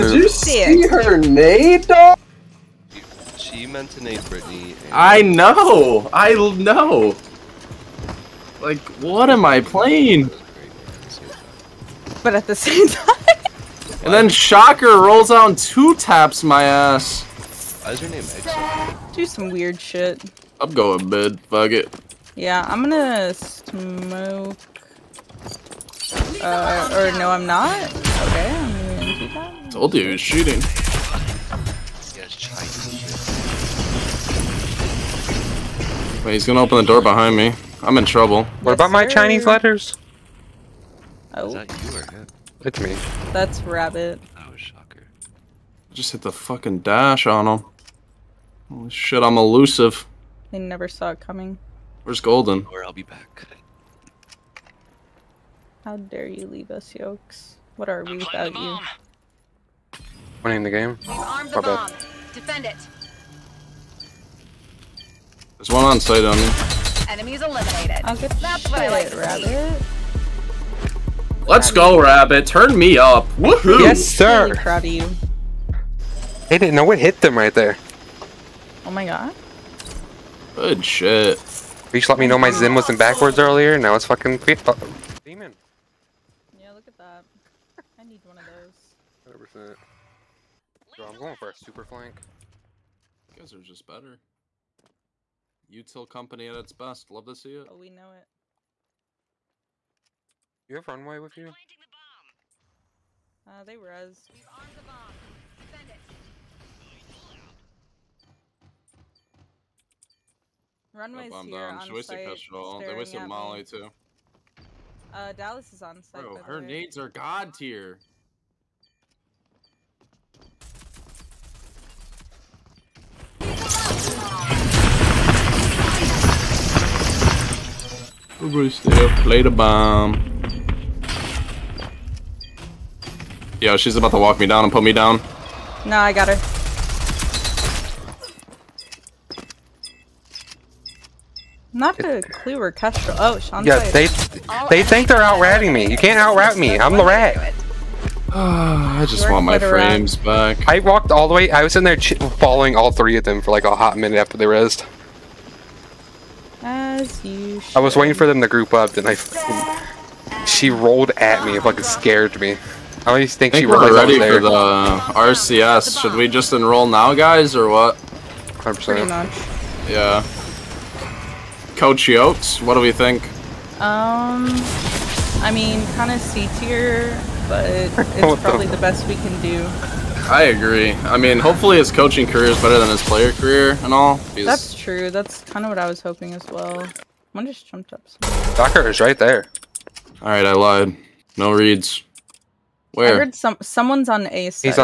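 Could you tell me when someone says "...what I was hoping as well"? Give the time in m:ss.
3:05.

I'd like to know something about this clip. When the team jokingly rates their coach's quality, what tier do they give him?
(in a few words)
C tier.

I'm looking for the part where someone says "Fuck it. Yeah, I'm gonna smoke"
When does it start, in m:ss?
0:21.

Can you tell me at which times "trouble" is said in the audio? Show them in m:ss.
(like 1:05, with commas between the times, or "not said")
0:38.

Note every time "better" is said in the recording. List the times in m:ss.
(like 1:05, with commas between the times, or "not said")
1:33, 3:02.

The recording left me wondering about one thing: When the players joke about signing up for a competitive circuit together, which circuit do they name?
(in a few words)
RCS.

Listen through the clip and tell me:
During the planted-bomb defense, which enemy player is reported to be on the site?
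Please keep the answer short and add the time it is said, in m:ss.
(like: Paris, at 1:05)
Dallas, at 1:55.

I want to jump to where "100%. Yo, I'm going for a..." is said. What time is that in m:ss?
1:29.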